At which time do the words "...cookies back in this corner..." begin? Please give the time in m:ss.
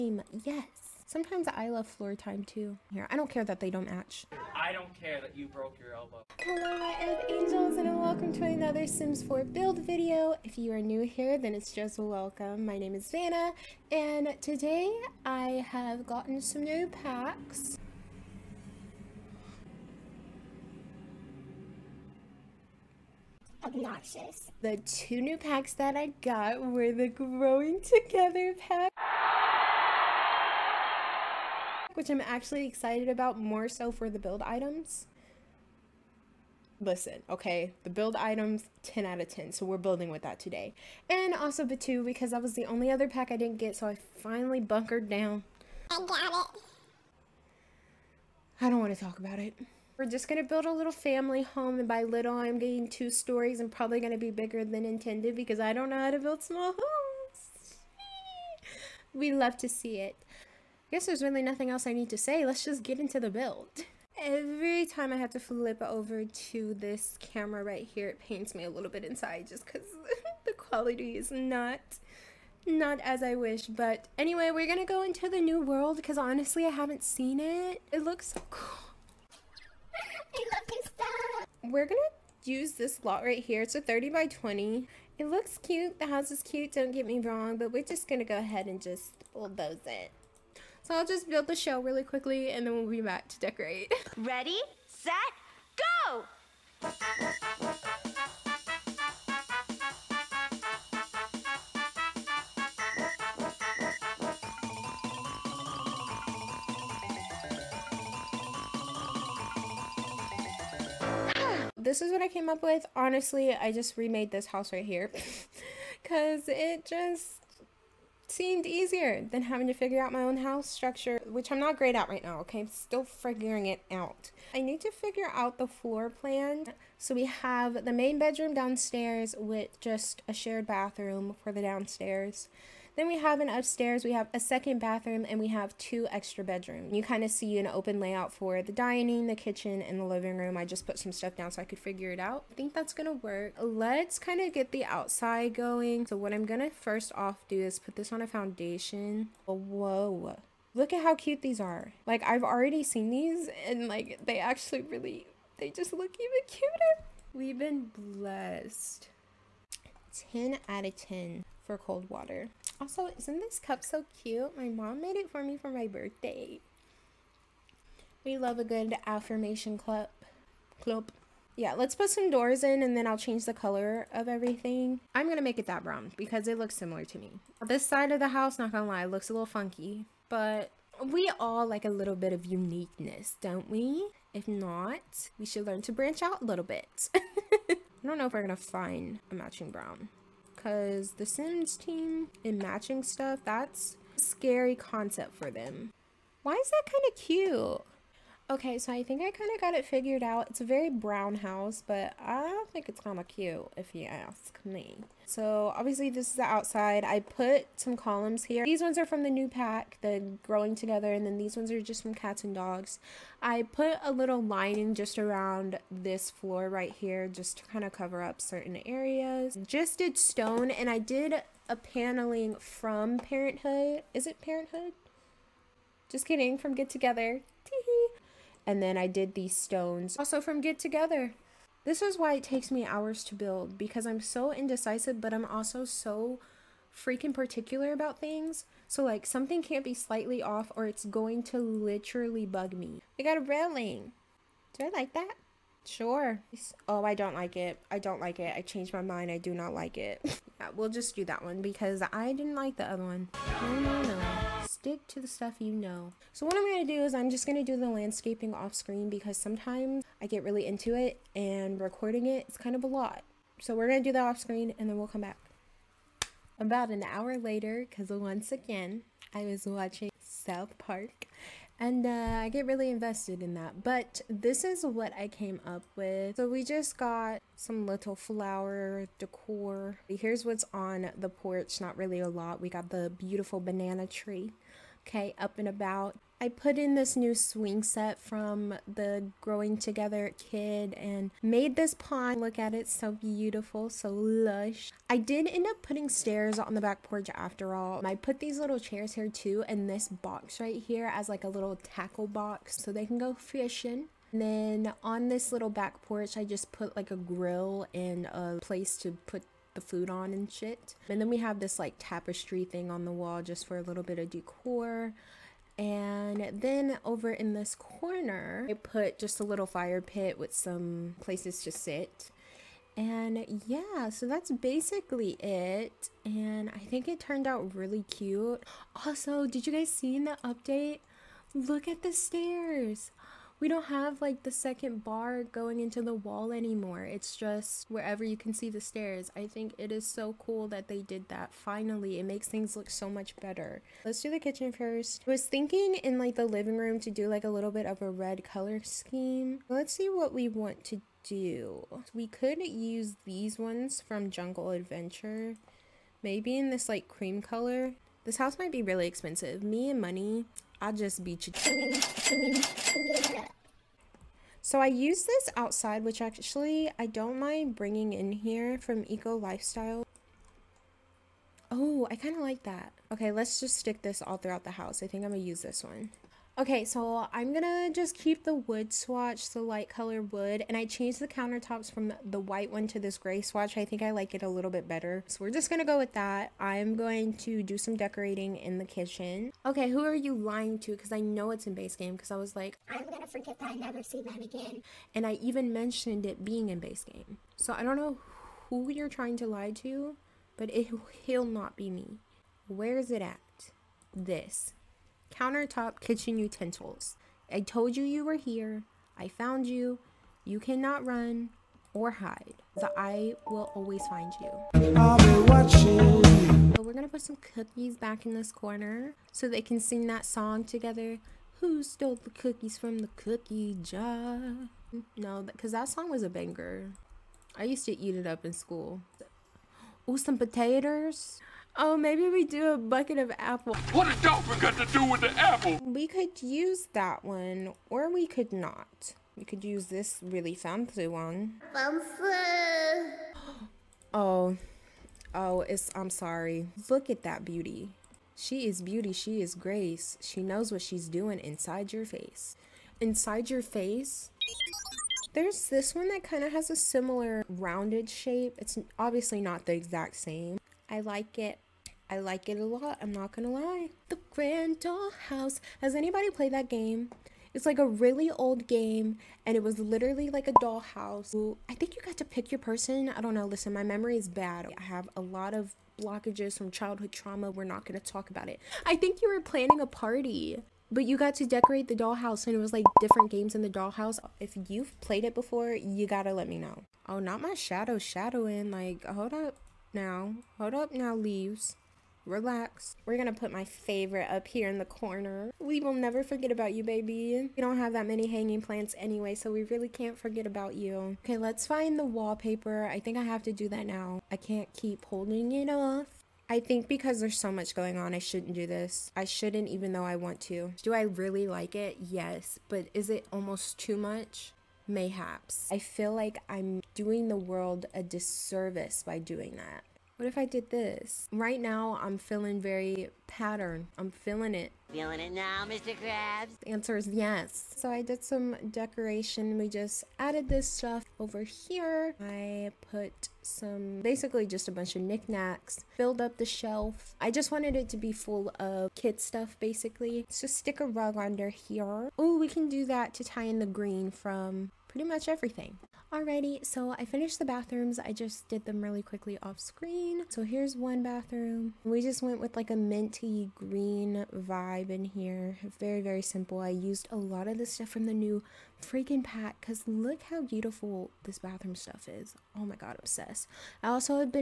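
6:57.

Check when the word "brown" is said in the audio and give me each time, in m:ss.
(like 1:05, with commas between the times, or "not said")
2:55, 3:09, 3:20.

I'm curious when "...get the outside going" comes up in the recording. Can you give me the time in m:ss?
2:24.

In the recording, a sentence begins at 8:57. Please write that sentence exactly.
I just wanted it to be full of kid stuff, basically.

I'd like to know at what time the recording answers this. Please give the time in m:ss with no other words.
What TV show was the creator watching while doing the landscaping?
4:30.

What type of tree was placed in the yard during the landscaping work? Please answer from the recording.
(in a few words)
Banana tree.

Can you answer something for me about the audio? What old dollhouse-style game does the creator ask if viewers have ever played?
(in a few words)
The Grand Dollhouse.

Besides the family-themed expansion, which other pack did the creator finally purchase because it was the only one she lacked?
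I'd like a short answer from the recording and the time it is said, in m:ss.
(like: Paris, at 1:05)
Batuu, at 0:41.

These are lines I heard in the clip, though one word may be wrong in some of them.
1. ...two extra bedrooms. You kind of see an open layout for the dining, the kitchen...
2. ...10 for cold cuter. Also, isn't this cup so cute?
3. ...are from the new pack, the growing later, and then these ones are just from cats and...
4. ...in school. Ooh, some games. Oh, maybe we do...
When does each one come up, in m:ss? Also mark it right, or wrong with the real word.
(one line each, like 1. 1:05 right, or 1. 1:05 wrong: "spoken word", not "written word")
1. 2:15 right
2. 2:40 wrong: "water", not "cuter"
3. 3:28 wrong: "together", not "later"
4. 7:08 wrong: "potatoes", not "games".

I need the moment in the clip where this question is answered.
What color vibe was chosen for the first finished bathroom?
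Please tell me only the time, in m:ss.
9:12.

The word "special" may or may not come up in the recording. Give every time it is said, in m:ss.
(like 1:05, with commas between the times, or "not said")
not said.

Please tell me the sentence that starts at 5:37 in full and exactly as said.
It's just wherever you can see the stairs.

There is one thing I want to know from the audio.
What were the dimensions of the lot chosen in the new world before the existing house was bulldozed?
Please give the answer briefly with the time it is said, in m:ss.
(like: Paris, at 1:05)
30 by 20, at 1:23.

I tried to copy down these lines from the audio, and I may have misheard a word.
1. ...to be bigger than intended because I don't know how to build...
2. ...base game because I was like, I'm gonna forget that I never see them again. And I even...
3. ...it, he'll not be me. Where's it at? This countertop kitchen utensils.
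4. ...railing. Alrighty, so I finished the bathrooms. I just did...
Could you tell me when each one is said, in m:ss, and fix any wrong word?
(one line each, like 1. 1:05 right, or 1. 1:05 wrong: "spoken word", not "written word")
1. 0:54 right
2. 6:31 right
3. 6:40 right
4. 9:05 wrong: "everything", not "railing".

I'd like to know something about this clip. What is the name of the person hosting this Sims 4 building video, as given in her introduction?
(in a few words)
Vanna.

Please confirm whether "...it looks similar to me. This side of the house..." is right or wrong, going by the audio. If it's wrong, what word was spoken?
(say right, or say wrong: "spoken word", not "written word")
right.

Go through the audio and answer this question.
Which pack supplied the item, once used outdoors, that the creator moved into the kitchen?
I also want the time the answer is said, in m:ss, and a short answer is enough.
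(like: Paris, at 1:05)
Eco Lifestyle, at 6:09.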